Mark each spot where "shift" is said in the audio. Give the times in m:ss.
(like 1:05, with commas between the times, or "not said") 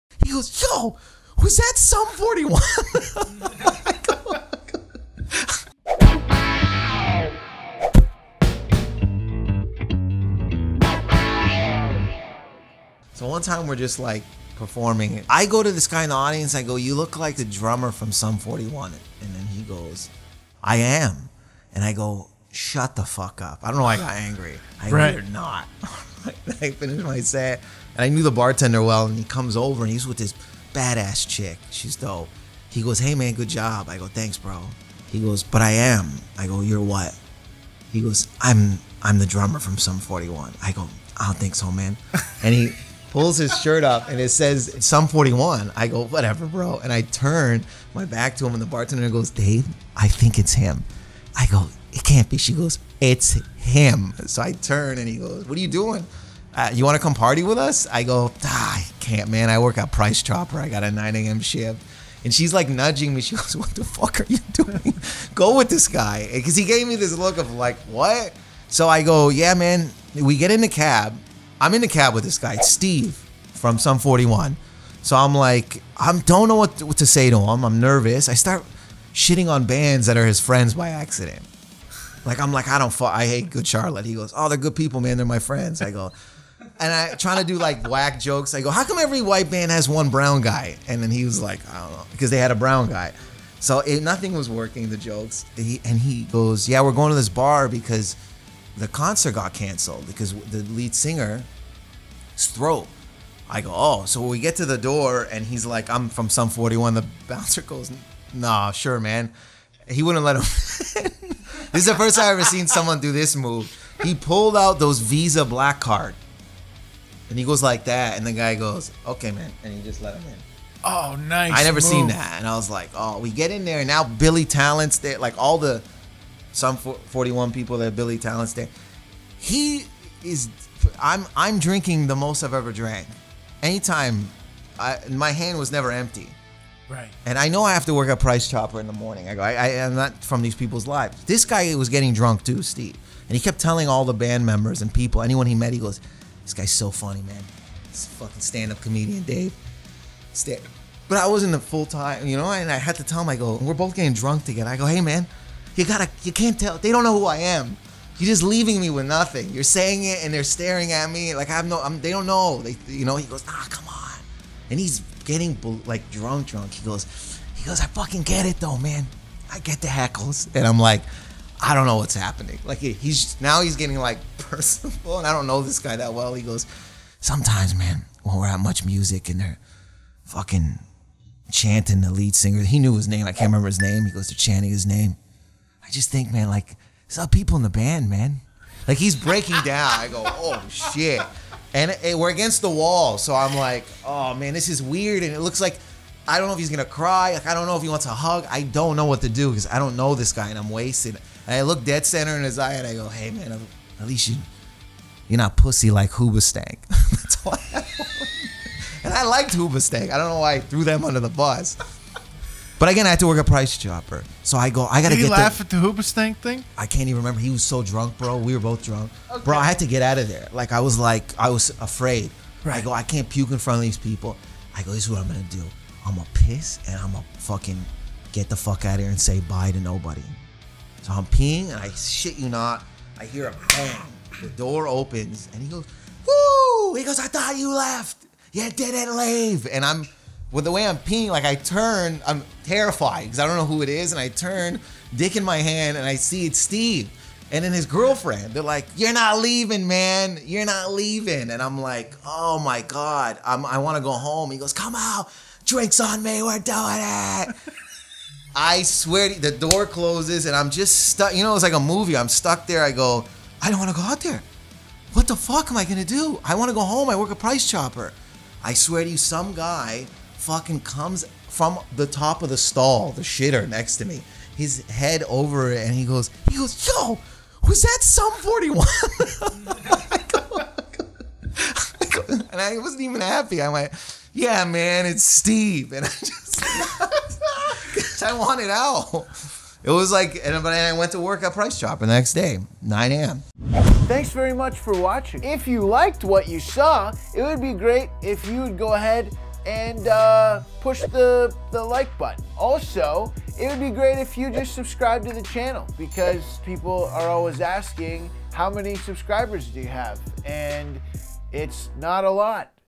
1:01.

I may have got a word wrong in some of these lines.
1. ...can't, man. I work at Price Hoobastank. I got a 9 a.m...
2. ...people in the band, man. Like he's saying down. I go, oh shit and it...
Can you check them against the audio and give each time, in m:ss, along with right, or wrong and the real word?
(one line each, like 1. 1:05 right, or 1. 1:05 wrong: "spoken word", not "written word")
1. 0:59 wrong: "Chopper", not "Hoobastank"
2. 3:07 wrong: "breaking", not "saying".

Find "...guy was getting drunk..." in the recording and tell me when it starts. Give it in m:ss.
2:21.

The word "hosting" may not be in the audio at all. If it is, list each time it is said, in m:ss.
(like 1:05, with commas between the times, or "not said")
not said.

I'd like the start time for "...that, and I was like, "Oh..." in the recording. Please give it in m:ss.
2:02.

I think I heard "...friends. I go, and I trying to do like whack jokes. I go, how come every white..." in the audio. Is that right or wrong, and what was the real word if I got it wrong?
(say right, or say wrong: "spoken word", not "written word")
right.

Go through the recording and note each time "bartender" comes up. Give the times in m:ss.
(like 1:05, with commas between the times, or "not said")
0:28, 0:48.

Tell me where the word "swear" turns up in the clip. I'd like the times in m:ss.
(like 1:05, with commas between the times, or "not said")
4:18, 4:28.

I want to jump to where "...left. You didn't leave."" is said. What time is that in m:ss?
3:57.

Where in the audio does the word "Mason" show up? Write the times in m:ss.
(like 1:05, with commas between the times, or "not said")
not said.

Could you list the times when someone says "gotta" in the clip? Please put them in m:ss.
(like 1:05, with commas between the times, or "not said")
2:35, 3:35.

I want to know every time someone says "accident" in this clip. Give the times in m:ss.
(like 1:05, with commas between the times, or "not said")
1:20.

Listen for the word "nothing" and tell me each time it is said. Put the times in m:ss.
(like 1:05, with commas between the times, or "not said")
1:34, 2:39.